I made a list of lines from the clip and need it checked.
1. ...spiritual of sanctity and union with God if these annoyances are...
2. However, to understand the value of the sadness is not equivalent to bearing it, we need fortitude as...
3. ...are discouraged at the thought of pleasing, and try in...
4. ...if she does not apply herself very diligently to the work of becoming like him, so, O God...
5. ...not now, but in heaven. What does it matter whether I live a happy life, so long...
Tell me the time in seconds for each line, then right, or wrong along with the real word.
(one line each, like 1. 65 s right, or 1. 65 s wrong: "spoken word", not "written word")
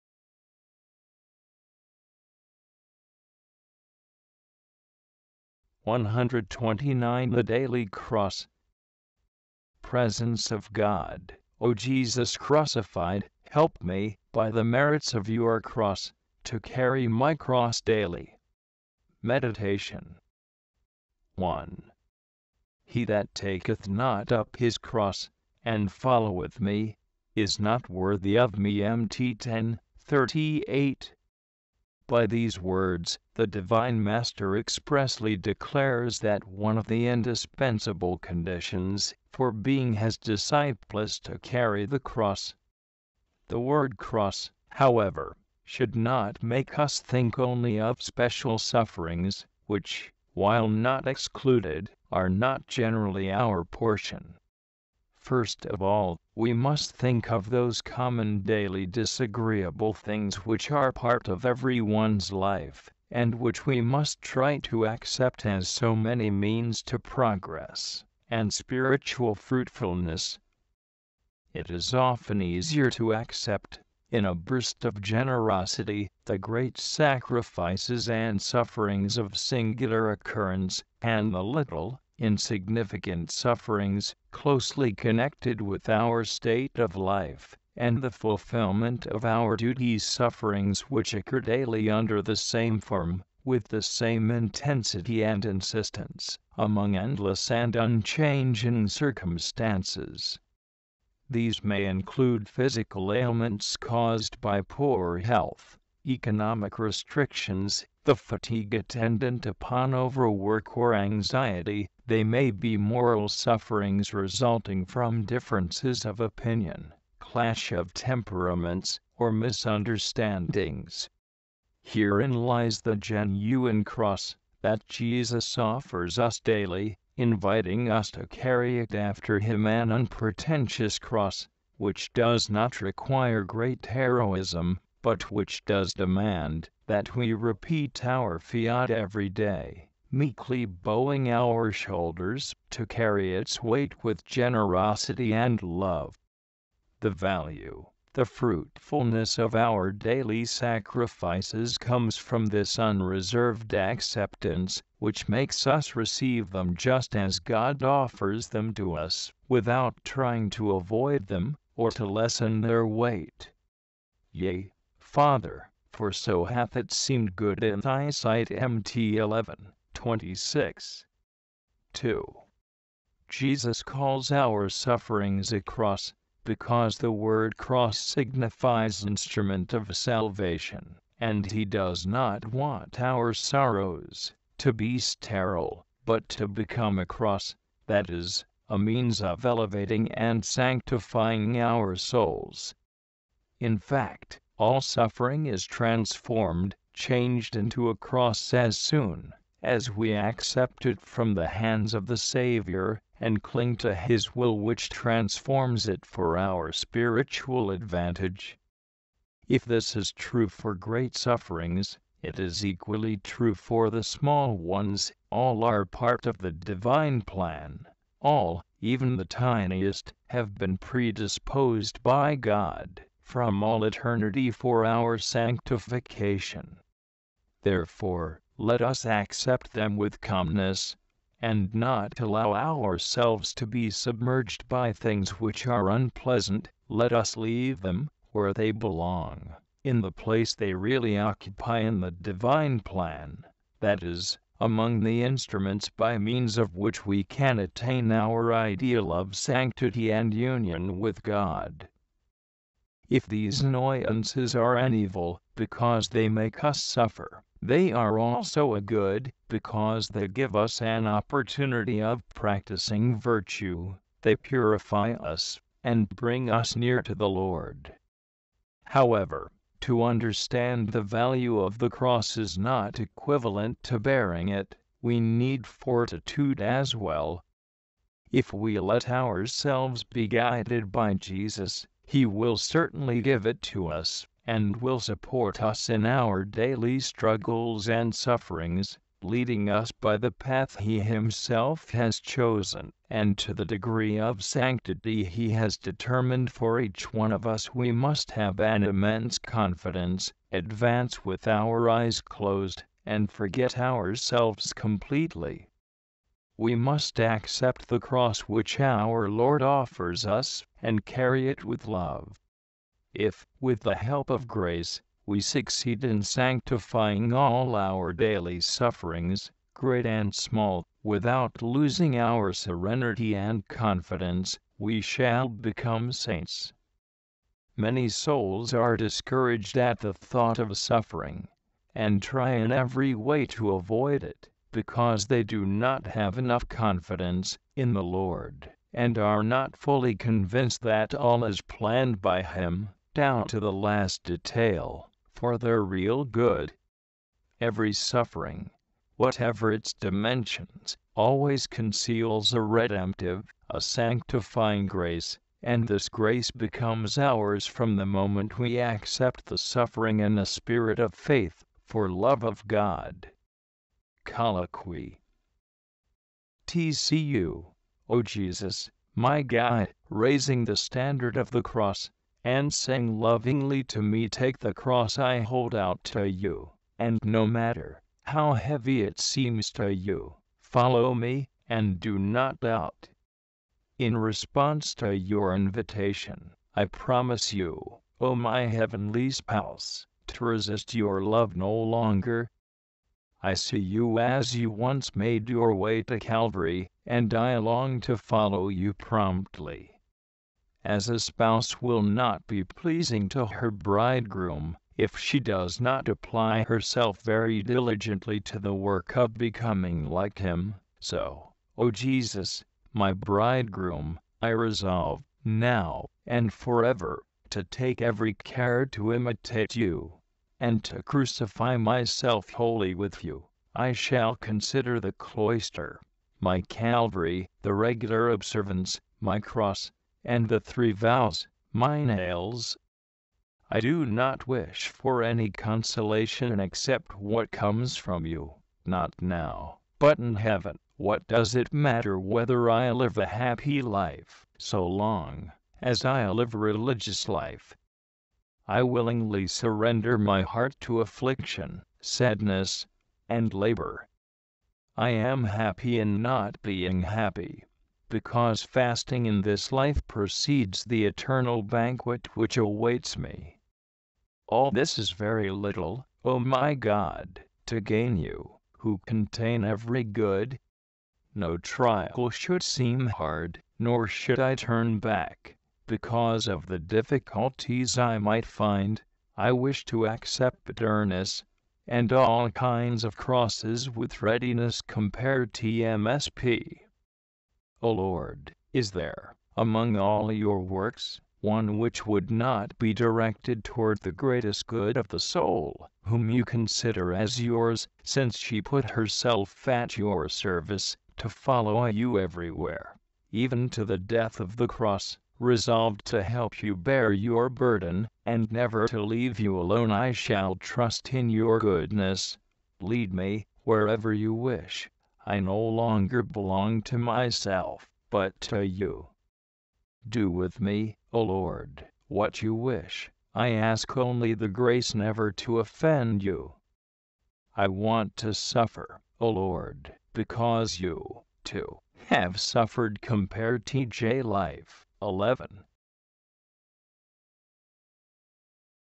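1. 248 s wrong: "ideal", not "spiritual"
2. 268 s wrong: "cross", not "sadness"
3. 328 s wrong: "suffering", not "pleasing"
4. 404 s wrong: "Jesus", not "God"
5. 438 s right.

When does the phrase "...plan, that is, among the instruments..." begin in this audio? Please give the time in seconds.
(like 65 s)
242 s.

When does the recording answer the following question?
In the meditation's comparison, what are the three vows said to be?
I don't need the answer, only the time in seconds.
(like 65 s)
431 s.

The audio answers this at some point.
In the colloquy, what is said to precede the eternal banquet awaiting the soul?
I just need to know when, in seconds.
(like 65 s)
458 s.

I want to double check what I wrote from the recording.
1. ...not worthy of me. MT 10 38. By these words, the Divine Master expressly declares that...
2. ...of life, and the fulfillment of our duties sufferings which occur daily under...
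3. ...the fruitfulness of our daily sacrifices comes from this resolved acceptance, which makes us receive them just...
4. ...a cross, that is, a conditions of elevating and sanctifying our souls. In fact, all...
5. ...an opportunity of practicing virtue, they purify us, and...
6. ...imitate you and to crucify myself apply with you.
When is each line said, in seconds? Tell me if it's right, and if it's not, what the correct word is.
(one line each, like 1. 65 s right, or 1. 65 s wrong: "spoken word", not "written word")
1. 27 s right
2. 86 s right
3. 148 s wrong: "unreserved", not "resolved"
4. 186 s wrong: "means", not "conditions"
5. 260 s right
6. 419 s wrong: "wholly", not "apply".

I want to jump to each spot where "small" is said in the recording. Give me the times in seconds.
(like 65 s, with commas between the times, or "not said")
214 s, 320 s.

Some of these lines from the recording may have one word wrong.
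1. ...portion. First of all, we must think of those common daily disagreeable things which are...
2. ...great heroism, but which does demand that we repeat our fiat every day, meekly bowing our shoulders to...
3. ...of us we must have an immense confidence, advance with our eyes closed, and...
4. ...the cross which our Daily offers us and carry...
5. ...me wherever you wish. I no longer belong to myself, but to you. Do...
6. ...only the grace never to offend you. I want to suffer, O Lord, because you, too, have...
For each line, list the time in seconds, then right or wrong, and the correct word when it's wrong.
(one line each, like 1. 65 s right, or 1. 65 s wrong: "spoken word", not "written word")
1. 53 s right
2. 133 s right
3. 297 s right
4. 307 s wrong: "Lord", not "Daily"
5. 513 s right
6. 523 s right.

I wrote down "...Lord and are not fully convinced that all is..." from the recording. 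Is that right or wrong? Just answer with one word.
right.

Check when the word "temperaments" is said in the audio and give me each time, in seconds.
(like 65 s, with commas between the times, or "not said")
117 s.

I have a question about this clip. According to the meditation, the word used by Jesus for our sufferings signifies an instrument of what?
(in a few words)
Salvation.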